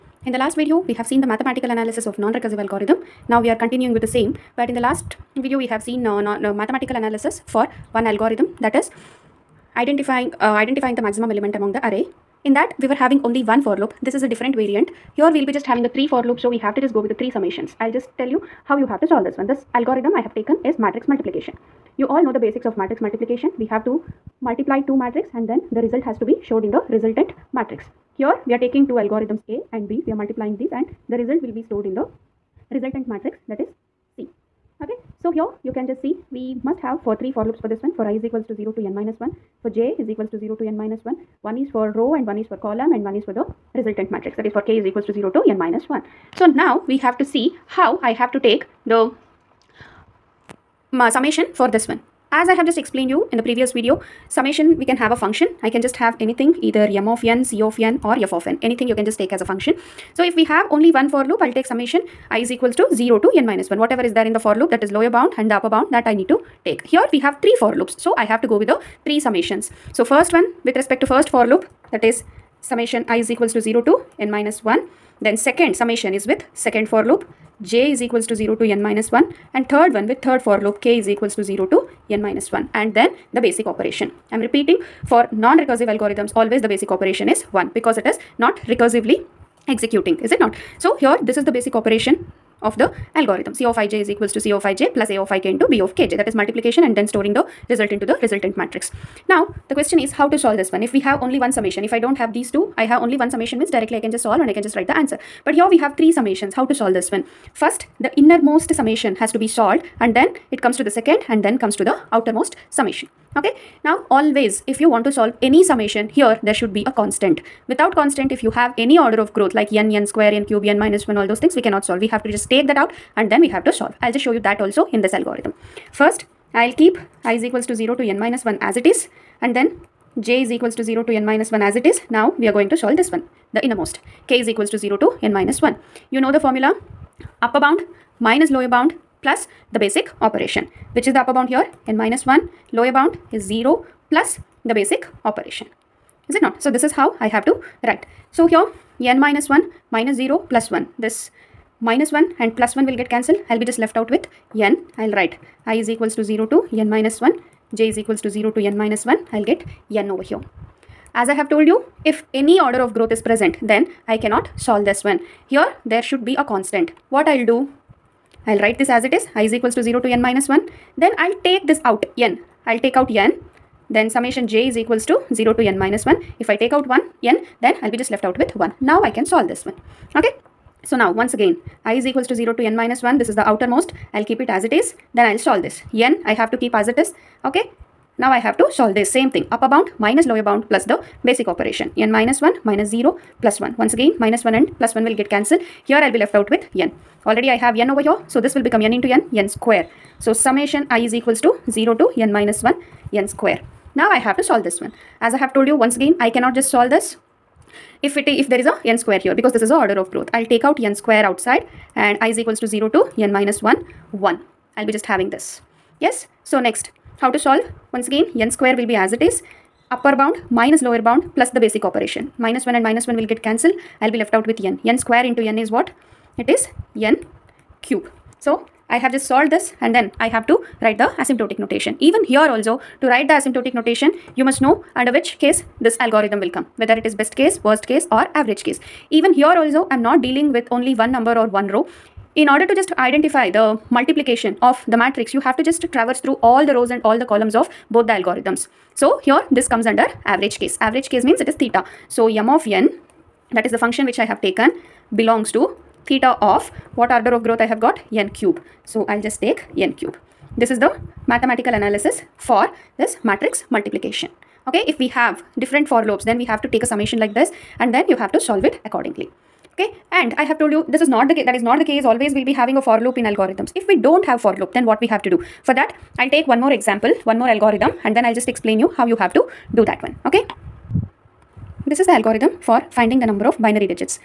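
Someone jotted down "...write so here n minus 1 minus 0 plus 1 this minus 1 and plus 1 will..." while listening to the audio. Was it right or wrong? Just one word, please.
right.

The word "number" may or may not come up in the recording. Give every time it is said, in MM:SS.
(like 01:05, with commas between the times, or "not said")
04:01, 04:43.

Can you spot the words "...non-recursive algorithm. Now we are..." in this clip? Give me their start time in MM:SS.
00:02.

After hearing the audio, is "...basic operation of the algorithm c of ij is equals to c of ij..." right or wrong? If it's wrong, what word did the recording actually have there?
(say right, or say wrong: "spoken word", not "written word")
right.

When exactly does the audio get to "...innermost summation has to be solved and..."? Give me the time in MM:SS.
01:48.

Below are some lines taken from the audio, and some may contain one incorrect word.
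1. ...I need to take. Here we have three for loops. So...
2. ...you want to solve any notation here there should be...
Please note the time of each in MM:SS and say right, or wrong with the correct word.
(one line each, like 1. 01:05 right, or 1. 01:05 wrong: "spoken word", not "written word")
1. 01:06 right
2. 01:54 wrong: "summation", not "notation".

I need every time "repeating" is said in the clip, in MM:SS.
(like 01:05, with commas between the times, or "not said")
01:24.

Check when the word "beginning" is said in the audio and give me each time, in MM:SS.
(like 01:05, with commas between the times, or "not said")
not said.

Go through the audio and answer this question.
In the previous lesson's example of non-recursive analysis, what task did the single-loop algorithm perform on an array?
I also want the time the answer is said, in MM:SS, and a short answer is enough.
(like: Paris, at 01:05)
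identifying the maximum element, at 00:10.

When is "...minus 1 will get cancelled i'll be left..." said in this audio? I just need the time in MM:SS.
03:42.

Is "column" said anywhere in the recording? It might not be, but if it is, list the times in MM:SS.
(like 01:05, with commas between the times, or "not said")
00:42, 04:07.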